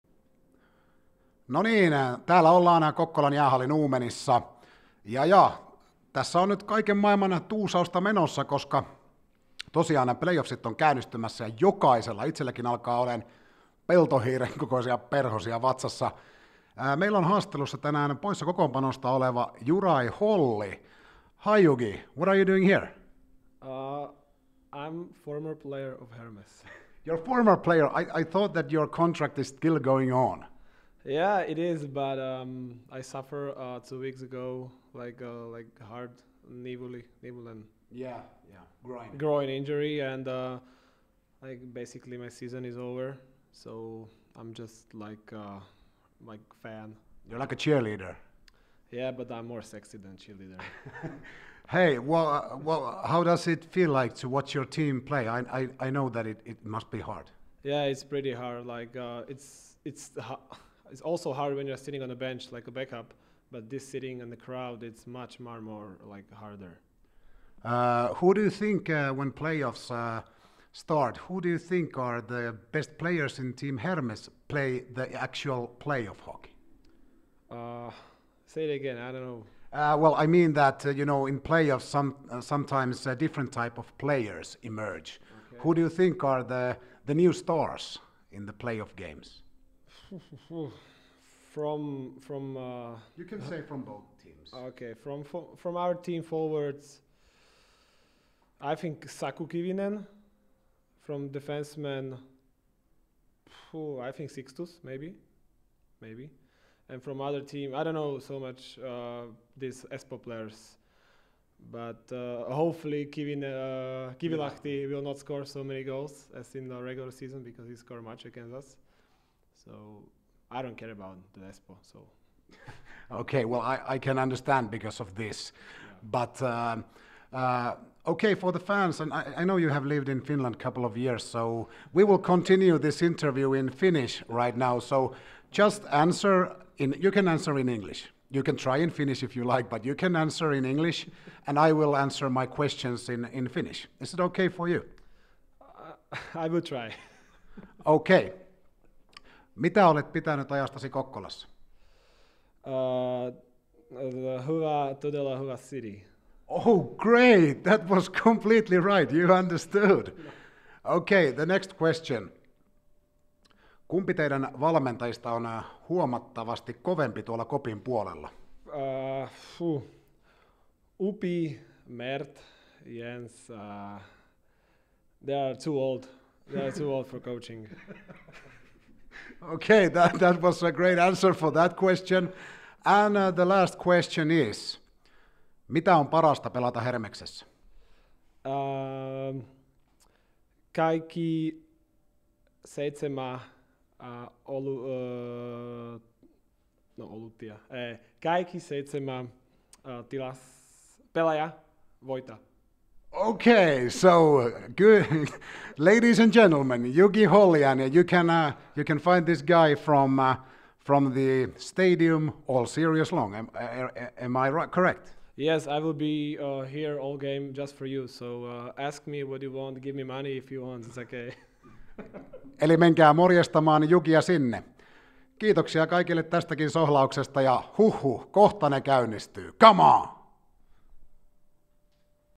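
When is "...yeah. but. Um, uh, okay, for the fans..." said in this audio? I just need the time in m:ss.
2:05.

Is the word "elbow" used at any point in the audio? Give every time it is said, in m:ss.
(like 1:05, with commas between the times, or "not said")
not said.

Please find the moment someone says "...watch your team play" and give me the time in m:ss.
0:54.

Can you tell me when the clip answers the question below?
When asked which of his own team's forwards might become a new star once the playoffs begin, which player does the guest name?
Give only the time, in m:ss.
1:39.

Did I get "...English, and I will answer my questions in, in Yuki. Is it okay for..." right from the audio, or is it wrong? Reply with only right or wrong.
wrong.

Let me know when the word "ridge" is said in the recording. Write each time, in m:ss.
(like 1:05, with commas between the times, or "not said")
not said.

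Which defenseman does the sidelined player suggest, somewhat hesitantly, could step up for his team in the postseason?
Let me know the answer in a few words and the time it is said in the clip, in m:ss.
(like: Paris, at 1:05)
Sixtus, at 1:44.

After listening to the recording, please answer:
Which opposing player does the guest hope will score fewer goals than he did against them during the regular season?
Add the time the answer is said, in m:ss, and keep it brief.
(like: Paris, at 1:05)
Kivilahti, at 1:54.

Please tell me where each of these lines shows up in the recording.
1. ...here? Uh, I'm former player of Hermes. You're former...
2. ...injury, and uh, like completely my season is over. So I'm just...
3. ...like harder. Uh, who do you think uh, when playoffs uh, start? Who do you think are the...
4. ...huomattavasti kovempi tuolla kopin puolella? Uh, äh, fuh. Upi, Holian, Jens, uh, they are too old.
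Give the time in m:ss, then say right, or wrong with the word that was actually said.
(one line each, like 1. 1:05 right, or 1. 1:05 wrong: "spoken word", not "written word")
1. 0:22 right
2. 0:39 wrong: "basically", not "completely"
3. 1:06 right
4. 2:45 wrong: "Mert", not "Holian".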